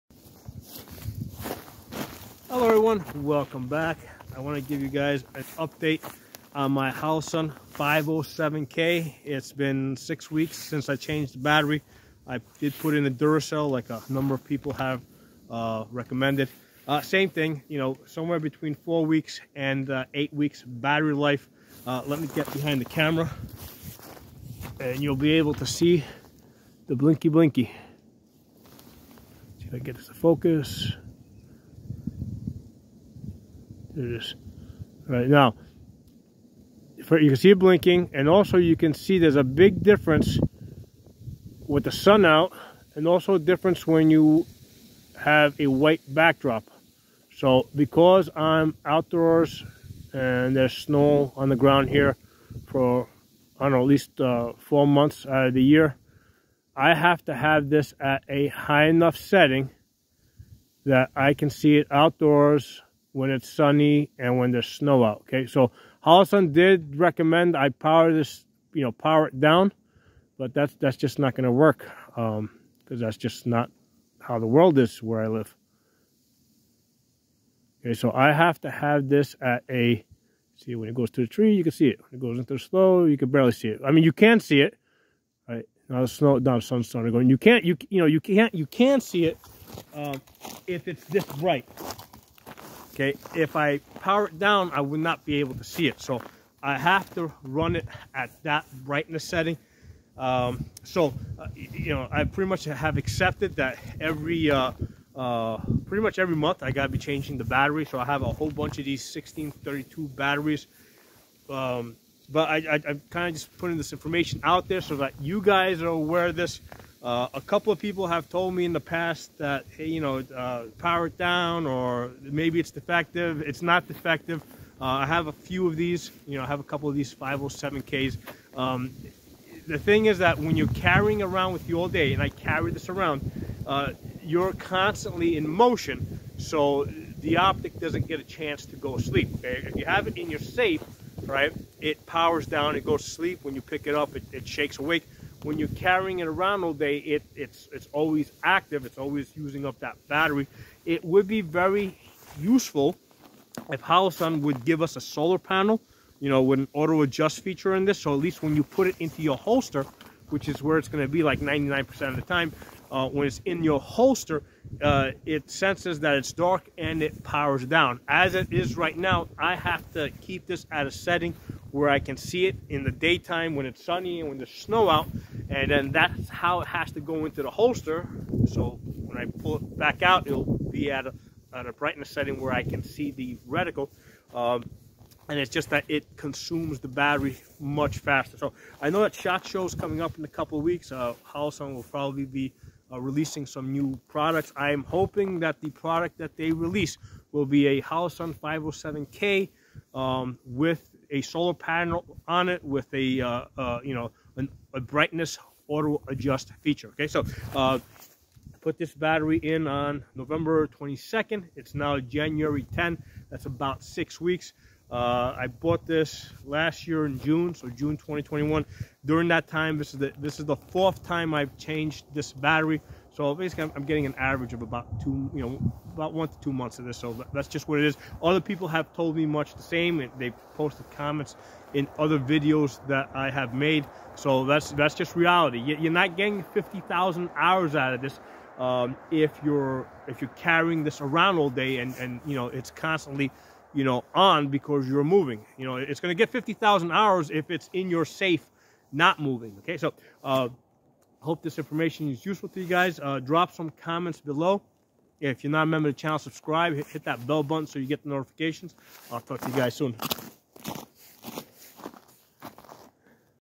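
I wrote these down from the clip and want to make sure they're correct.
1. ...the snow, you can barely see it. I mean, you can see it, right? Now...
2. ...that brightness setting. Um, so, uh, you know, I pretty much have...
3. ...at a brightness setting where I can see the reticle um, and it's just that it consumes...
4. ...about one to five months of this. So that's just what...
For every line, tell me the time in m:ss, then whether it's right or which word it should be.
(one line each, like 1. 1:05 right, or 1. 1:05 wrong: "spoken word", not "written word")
1. 1:22 right
2. 1:38 right
3. 3:01 right
4. 3:45 wrong: "two", not "five".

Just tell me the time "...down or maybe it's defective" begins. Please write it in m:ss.
2:01.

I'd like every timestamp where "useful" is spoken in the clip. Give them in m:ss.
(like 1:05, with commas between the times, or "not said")
2:32, 4:12.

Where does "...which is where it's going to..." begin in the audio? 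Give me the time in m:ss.
2:40.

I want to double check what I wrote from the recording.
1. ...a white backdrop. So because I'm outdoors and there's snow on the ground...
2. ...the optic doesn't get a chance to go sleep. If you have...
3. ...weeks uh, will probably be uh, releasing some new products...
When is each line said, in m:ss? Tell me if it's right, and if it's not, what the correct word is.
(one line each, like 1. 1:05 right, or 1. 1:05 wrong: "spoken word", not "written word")
1. 0:45 right
2. 2:16 right
3. 3:10 right.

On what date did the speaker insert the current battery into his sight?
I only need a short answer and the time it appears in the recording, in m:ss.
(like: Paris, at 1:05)
November 22, at 3:30.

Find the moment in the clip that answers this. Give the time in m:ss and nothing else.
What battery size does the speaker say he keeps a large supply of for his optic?
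1:49.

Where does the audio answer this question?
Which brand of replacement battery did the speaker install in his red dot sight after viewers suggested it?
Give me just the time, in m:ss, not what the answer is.
0:13.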